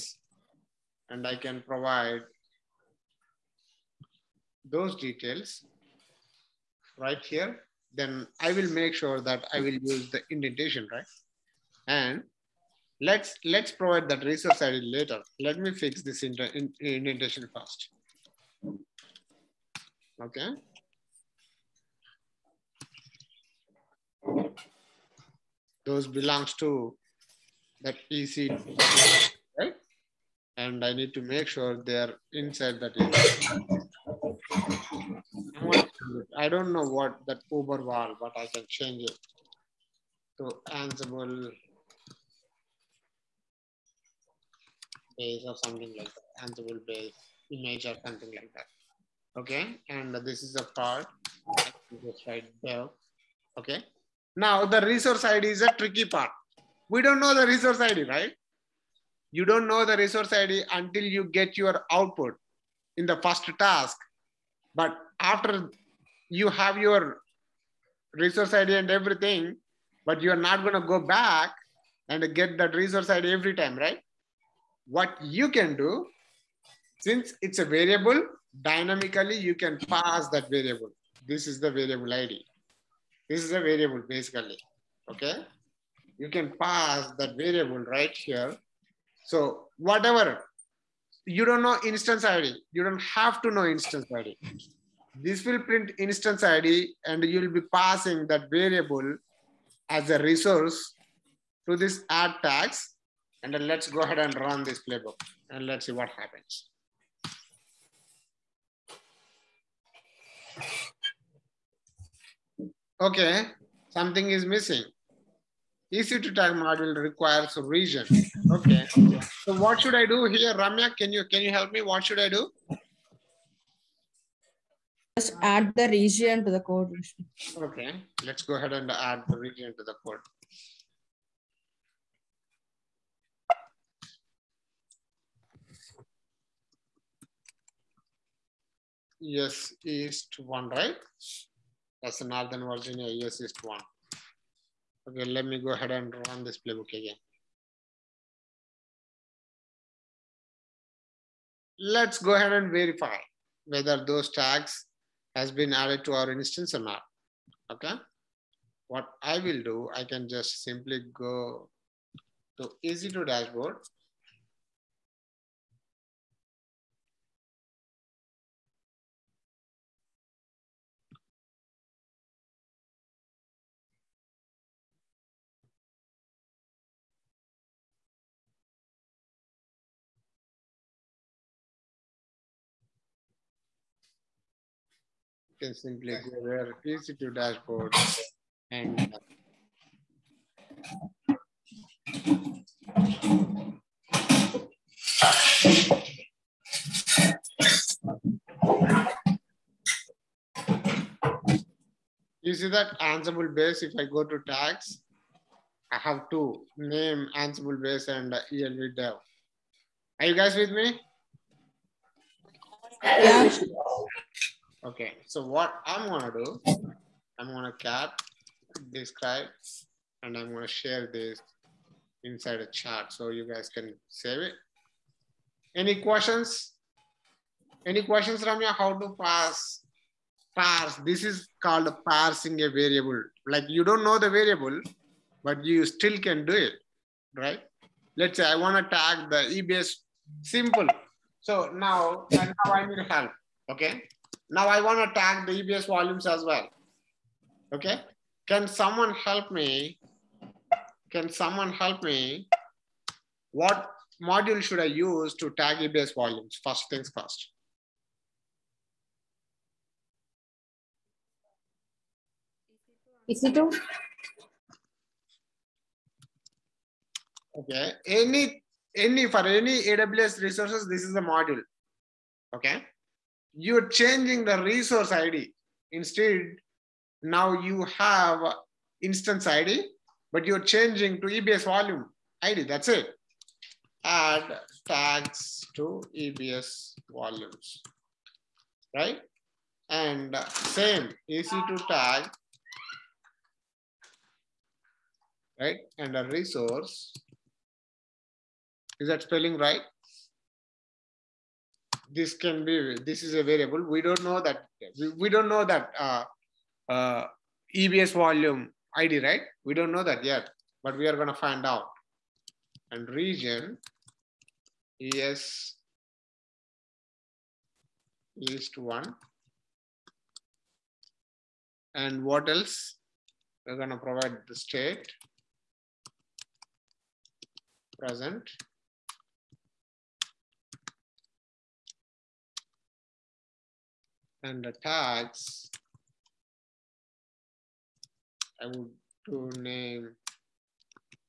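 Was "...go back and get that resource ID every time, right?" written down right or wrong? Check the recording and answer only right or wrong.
right.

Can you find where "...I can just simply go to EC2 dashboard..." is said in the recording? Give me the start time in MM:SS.
02:39.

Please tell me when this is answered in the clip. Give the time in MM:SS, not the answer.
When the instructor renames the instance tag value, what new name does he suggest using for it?
00:46.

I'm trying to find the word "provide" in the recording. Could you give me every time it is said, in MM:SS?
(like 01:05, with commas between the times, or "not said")
00:01, 00:13, 05:23.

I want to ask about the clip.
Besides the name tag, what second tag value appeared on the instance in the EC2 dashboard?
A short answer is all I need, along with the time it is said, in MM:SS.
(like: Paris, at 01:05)
ELV dev, at 03:28.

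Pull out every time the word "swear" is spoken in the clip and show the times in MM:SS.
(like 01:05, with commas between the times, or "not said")
not said.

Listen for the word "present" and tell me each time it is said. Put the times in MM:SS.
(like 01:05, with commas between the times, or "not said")
05:27.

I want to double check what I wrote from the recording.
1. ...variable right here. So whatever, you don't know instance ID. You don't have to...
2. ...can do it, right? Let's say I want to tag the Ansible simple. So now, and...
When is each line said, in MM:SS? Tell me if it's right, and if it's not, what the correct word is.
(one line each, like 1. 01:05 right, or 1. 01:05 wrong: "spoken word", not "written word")
1. 01:27 right
2. 03:56 wrong: "EBS", not "Ansible".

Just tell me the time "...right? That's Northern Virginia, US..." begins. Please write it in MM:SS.
02:20.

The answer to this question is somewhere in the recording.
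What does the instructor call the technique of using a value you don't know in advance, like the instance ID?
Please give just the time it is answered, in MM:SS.
03:52.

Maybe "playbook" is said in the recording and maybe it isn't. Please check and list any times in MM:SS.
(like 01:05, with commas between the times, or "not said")
01:44, 02:26.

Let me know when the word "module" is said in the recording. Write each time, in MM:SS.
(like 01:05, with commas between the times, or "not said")
04:14, 04:31.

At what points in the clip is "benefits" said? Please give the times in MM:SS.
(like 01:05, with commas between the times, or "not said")
not said.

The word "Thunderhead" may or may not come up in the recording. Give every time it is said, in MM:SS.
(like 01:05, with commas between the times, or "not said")
not said.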